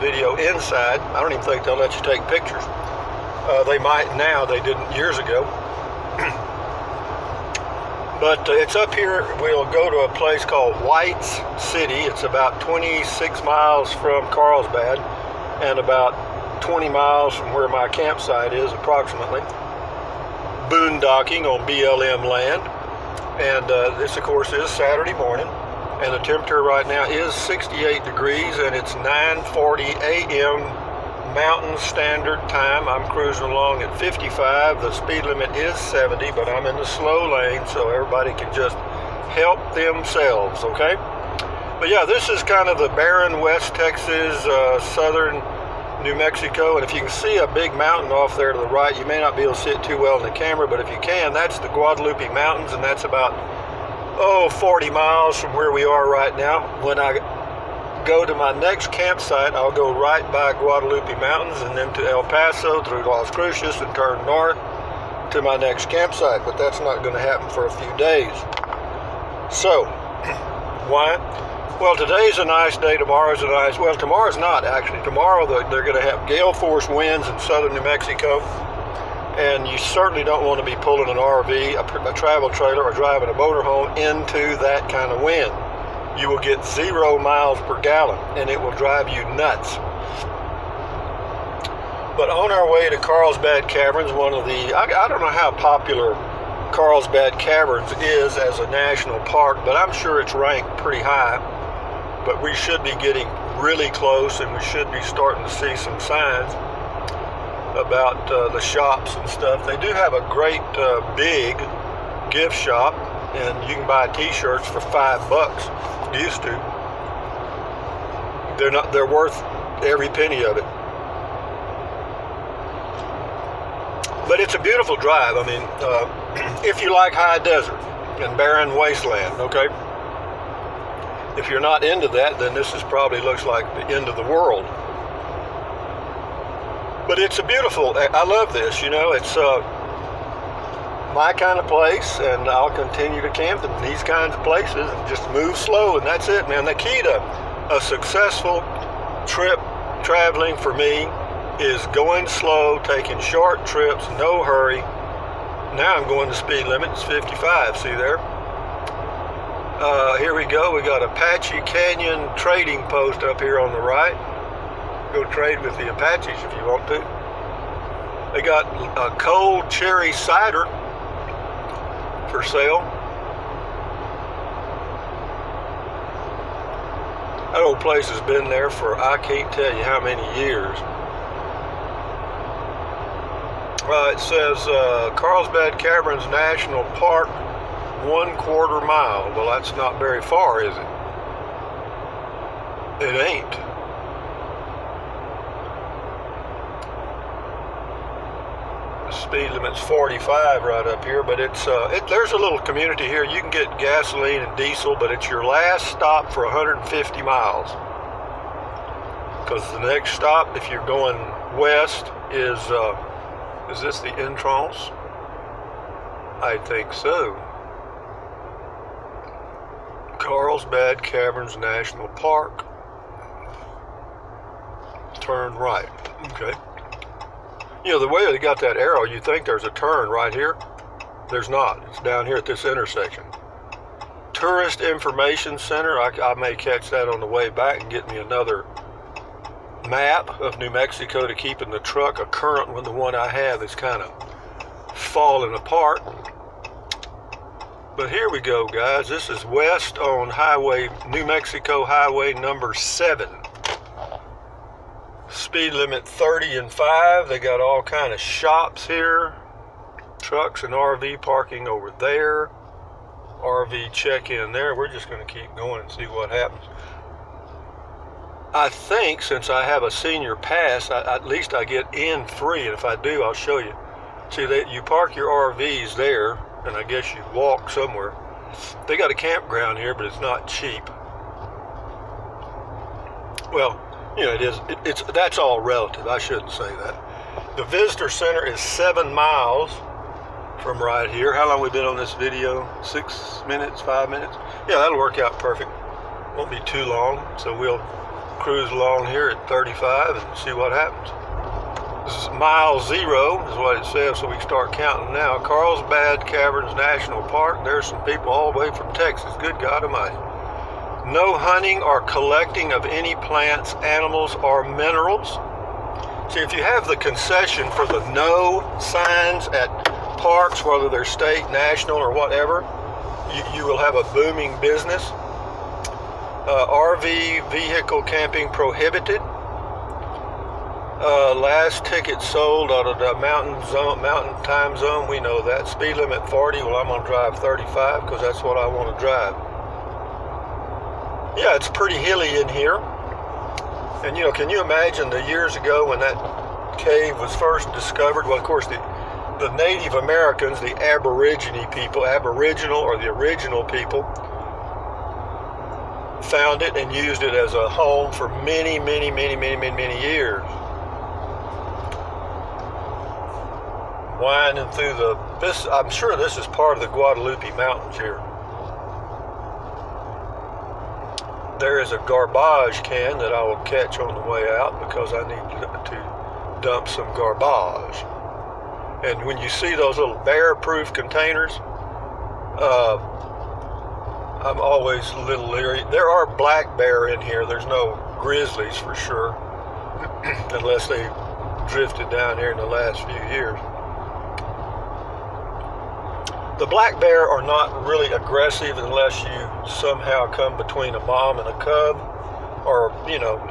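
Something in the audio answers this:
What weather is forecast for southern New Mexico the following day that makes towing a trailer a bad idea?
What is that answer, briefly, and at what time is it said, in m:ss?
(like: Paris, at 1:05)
Gale force winds, at 1:16.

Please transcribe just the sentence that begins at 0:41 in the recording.
But yeah, this is kind of the barren West Texas, uh, southern New Mexico.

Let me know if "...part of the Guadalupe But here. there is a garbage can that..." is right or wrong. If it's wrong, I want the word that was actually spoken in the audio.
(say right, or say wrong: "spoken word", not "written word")
wrong: "Mountains", not "But".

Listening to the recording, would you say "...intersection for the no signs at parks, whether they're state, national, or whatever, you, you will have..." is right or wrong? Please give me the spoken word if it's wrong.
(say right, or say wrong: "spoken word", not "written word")
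wrong: "concession", not "intersection".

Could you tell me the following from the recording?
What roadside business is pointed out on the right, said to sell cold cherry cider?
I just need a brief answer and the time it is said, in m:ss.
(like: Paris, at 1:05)
Apache Canyon Trading Post, at 2:41.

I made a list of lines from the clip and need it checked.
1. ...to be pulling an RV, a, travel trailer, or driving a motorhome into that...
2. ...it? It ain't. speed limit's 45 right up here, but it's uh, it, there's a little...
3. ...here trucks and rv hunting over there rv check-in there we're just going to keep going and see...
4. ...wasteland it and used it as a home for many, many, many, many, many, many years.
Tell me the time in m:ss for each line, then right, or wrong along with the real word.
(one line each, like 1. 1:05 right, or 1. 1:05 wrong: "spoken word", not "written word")
1. 1:20 right
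2. 3:13 right
3. 4:18 wrong: "parking", not "hunting"
4. 5:56 wrong: "found", not "wasteland".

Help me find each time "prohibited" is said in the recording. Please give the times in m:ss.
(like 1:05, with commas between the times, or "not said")
5:28.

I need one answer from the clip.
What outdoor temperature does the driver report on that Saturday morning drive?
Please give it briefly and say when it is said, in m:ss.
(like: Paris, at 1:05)
68 degrees, at 0:27.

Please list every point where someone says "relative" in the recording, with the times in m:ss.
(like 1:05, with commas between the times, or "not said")
4:45.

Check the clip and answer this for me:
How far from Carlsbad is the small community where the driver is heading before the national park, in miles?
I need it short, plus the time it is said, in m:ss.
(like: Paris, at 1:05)
26 miles, at 0:12.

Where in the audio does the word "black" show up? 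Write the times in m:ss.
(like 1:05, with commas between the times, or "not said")
6:26, 6:36.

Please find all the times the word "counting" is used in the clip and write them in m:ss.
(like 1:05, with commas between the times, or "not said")
5:04.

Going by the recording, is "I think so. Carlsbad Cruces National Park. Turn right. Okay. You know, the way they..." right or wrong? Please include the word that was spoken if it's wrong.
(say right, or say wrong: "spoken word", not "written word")
wrong: "Caverns", not "Cruces".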